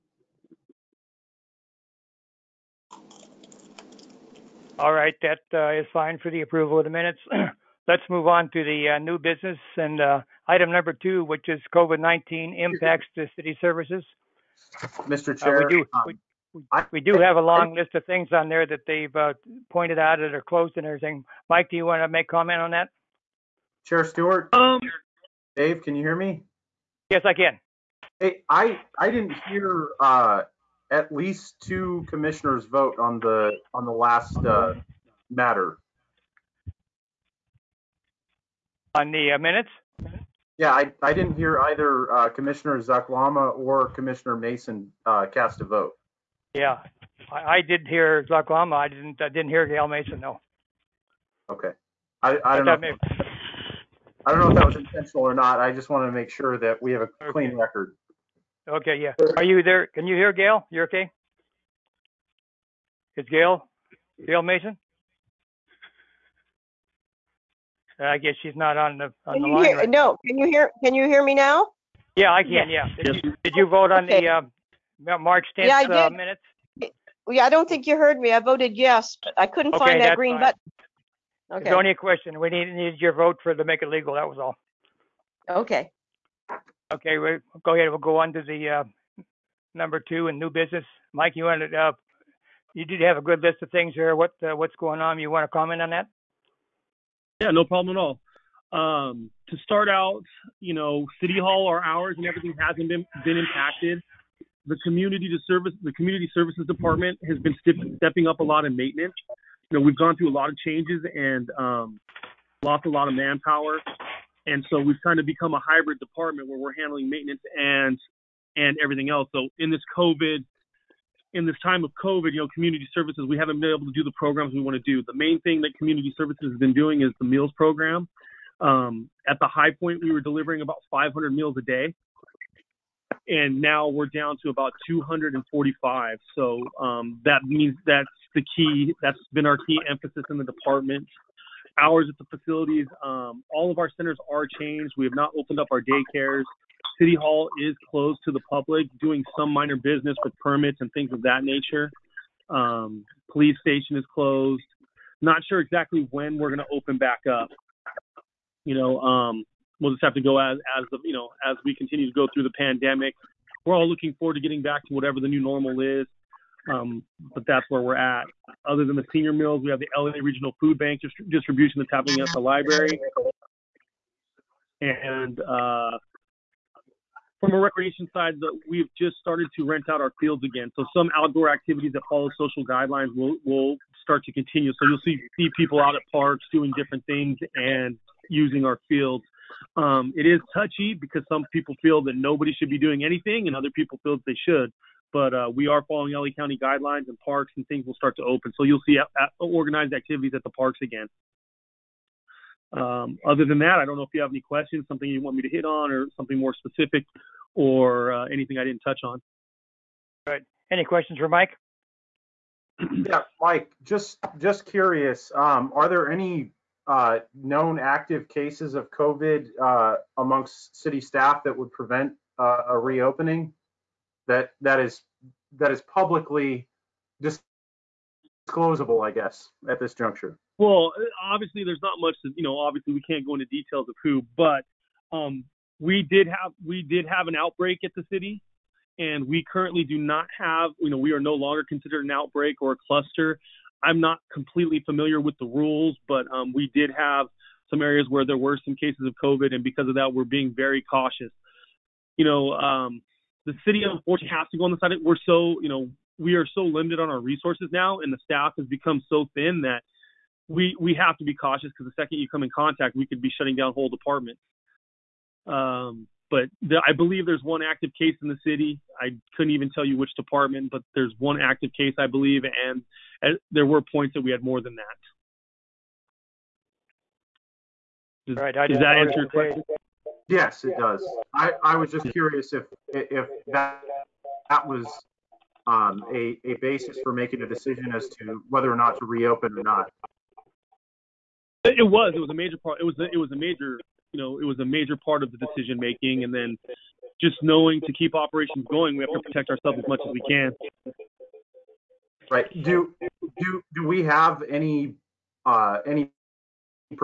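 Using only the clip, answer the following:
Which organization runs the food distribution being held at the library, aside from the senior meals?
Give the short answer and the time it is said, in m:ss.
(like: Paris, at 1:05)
LA Regional Food Bank, at 2:49.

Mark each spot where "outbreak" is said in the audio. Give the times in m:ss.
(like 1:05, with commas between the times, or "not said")
3:57, 4:02.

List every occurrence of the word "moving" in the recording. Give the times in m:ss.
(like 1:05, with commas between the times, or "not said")
not said.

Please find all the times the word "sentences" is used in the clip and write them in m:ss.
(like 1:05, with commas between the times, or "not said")
not said.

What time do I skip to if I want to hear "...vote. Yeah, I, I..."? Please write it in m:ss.
0:45.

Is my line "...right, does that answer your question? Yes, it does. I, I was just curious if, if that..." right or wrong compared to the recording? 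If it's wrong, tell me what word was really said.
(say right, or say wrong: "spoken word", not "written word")
right.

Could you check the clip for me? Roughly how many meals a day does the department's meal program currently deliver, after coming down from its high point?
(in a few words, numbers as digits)
245.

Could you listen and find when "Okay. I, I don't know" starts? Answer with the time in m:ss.
0:51.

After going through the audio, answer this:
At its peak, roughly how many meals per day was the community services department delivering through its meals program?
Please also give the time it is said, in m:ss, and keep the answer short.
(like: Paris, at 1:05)
500, at 2:10.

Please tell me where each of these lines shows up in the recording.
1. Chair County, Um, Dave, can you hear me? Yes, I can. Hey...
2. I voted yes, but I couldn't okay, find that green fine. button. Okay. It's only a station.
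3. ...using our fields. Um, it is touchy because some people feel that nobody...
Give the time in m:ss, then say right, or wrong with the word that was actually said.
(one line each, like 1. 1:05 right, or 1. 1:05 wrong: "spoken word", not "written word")
1. 0:23 wrong: "Stewart", not "County"
2. 1:18 wrong: "question", not "station"
3. 3:08 right.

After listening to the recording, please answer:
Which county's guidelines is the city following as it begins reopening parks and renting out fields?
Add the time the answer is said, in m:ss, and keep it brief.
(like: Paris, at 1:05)
LA County, at 3:16.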